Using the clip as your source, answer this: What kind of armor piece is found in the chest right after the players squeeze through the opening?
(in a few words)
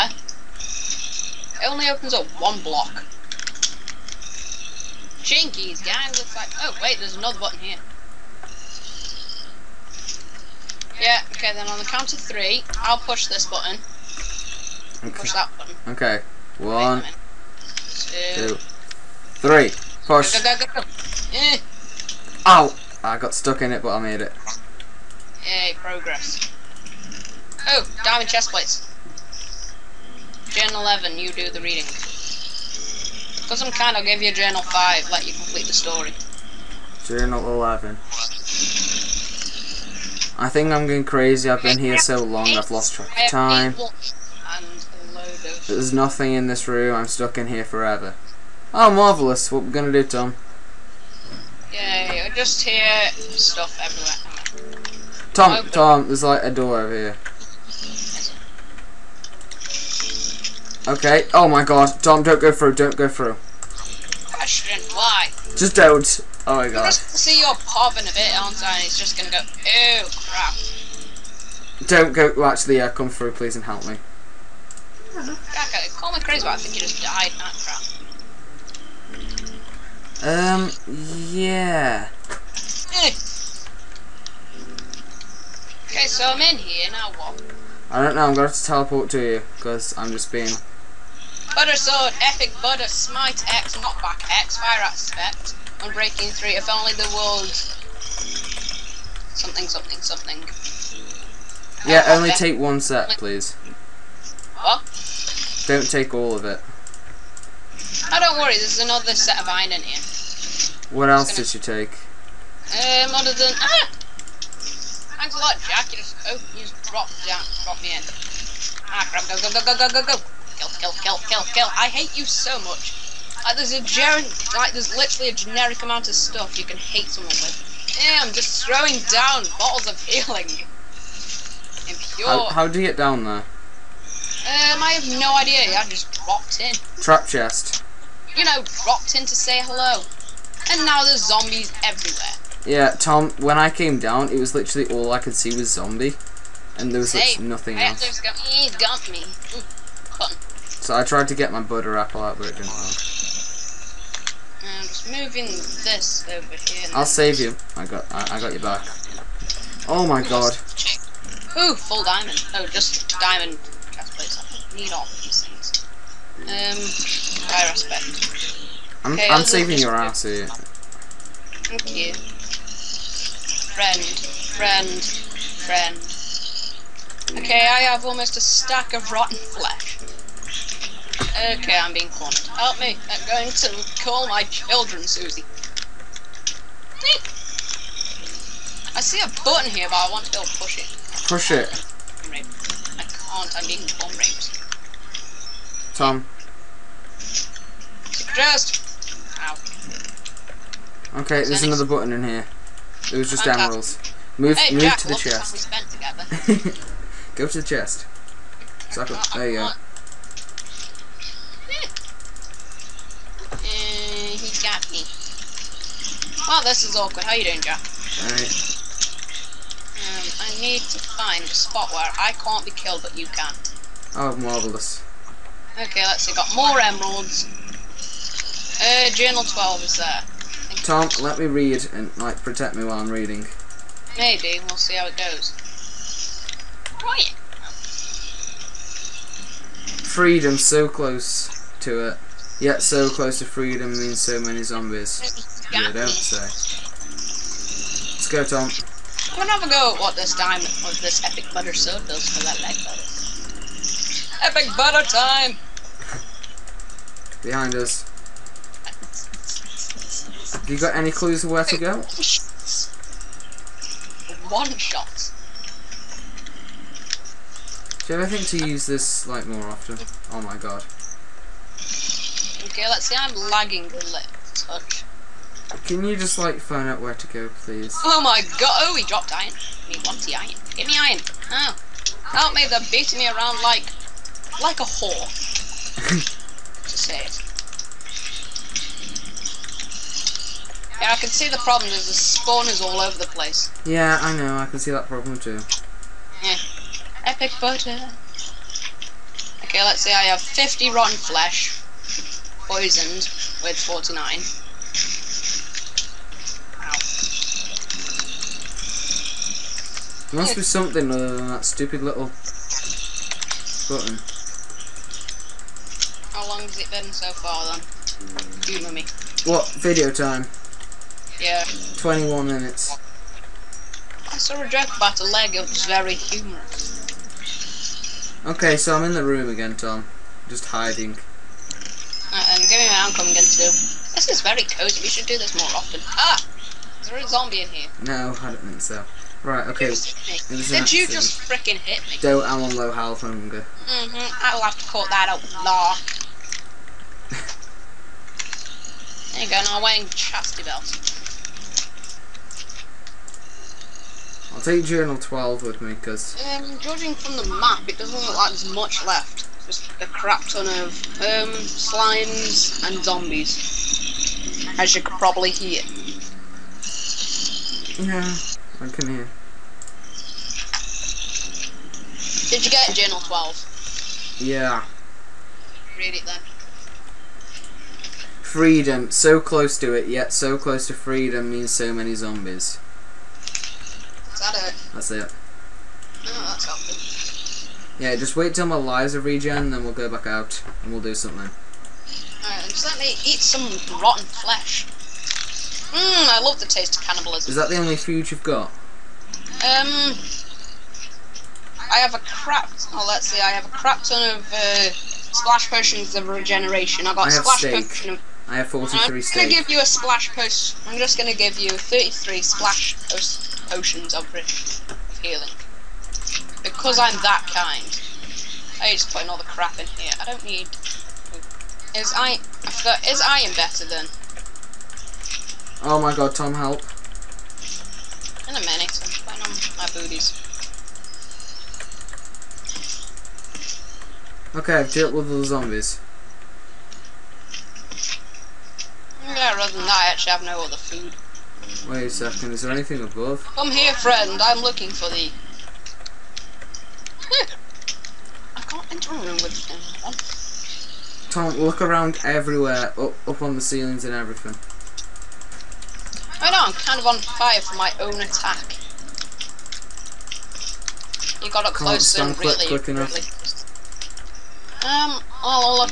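Diamond chest plates.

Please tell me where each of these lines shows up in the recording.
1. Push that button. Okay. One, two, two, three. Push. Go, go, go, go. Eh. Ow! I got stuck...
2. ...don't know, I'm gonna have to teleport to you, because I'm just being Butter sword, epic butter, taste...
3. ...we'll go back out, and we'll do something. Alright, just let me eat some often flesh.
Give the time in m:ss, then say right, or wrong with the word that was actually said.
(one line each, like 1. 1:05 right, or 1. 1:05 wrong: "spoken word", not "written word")
1. 0:15 right
2. 1:28 wrong: "smite", not "taste"
3. 6:29 wrong: "rotten", not "often".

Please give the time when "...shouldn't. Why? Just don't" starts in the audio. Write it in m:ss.
1:04.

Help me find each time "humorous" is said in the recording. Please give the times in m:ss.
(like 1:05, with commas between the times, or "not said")
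5:26.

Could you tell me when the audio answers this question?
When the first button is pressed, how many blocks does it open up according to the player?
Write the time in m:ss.
0:02.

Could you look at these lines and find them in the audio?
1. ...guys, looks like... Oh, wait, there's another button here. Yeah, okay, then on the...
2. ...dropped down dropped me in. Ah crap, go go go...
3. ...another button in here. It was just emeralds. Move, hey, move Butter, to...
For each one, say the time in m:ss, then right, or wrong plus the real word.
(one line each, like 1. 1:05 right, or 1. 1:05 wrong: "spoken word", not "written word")
1. 0:05 right
2. 1:56 right
3. 3:21 wrong: "Jack", not "Butter".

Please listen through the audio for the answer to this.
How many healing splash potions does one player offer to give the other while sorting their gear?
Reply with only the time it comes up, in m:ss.
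6:51.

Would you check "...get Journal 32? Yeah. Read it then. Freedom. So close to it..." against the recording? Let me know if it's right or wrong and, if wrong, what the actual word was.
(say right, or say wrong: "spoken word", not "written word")
wrong: "12", not "32".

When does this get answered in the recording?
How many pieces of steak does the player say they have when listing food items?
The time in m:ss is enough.
6:48.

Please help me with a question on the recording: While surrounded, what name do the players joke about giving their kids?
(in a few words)
Susie.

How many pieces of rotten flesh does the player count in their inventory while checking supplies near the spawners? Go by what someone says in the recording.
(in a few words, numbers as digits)
50.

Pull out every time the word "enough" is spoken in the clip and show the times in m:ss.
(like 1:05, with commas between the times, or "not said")
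7:42.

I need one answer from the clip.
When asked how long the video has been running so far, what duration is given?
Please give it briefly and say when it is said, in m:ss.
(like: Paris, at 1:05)
21 minutes, at 5:21.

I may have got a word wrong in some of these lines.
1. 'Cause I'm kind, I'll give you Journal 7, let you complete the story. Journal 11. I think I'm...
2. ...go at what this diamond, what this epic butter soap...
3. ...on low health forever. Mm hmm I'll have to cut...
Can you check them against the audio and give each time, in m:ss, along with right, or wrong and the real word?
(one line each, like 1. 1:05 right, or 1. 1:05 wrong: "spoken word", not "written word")
1. 0:33 wrong: "5", not "7"
2. 4:09 right
3. 5:42 wrong: "hunger", not "forever".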